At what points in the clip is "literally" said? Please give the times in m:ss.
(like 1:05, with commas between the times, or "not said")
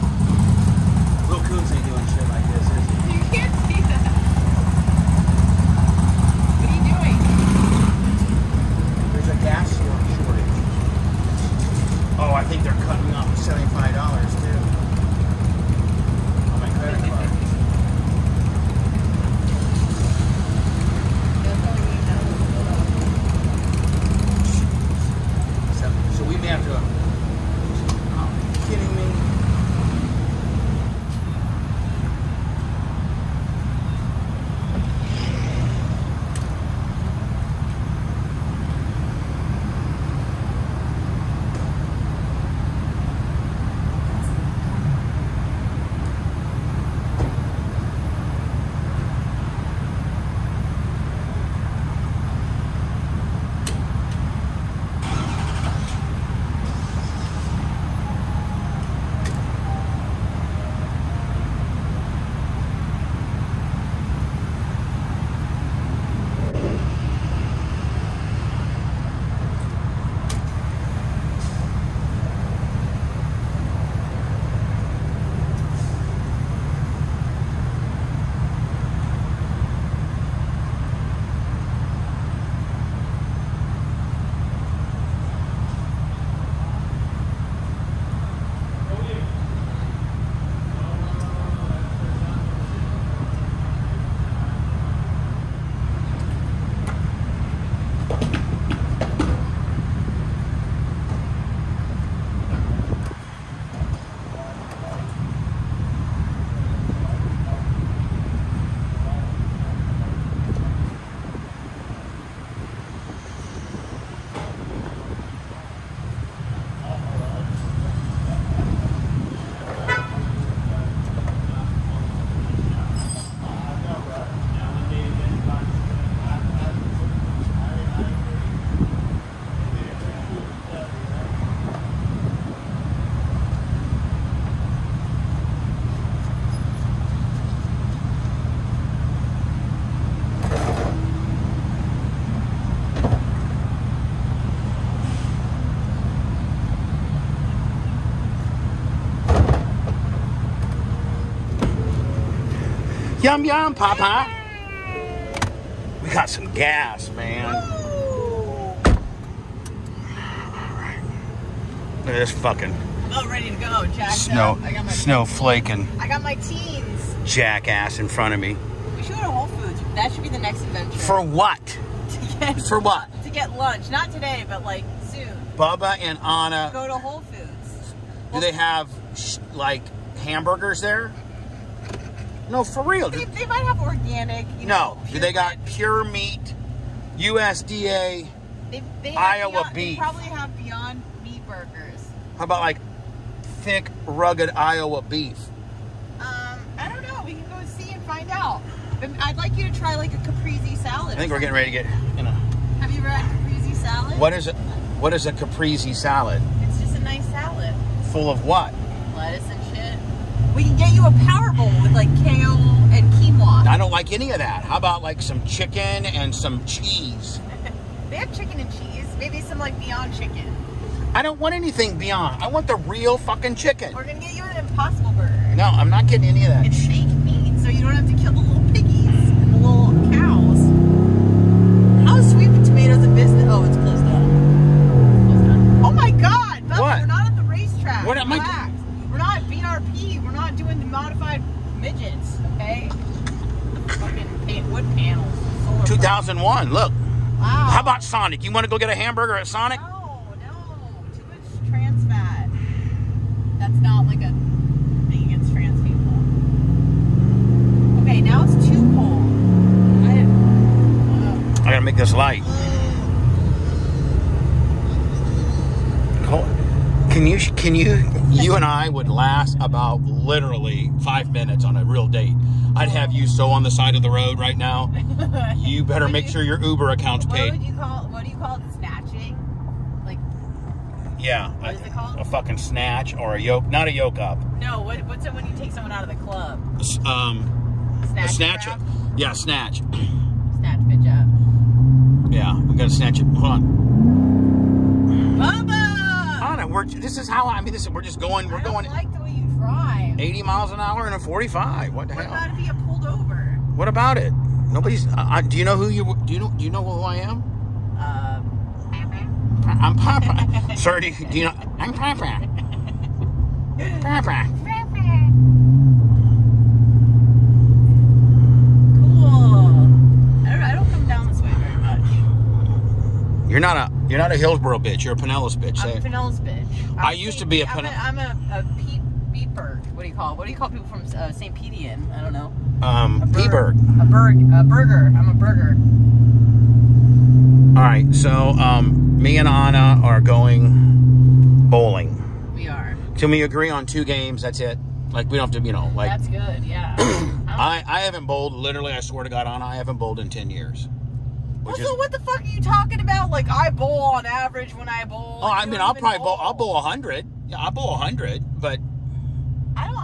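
4:30, 5:48.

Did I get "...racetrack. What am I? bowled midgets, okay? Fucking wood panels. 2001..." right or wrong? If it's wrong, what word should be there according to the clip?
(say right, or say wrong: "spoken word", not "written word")
wrong: "modified", not "bowled".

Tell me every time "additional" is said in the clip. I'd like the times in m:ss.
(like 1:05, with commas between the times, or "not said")
not said.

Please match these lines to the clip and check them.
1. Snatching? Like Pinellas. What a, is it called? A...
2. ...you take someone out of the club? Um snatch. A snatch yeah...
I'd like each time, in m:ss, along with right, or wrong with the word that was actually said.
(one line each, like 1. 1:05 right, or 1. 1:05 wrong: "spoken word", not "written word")
1. 4:38 wrong: "Yeah", not "Pinellas"
2. 4:45 right.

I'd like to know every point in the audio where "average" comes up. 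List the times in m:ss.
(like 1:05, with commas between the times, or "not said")
5:54.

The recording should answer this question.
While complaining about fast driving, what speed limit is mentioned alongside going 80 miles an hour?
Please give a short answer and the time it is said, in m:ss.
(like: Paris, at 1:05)
45, at 5:01.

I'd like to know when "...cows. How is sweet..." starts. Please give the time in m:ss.
3:50.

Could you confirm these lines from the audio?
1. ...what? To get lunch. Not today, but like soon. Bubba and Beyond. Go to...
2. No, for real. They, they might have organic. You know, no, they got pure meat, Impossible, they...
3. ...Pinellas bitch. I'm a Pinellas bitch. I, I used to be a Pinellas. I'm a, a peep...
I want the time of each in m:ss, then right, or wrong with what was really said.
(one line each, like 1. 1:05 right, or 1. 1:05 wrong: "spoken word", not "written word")
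1. 2:52 wrong: "Anna", not "Beyond"
2. 3:02 wrong: "USDA", not "Impossible"
3. 5:25 right.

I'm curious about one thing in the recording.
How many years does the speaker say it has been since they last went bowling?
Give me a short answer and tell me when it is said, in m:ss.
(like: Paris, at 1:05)
10, at 5:50.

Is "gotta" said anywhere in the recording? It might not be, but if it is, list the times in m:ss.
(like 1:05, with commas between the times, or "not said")
4:21, 4:52.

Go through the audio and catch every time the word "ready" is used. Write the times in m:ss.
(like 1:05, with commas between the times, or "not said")
2:43, 3:21.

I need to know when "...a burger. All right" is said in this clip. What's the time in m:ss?
5:35.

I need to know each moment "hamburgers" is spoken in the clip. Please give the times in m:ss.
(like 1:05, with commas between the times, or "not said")
3:00, 4:08.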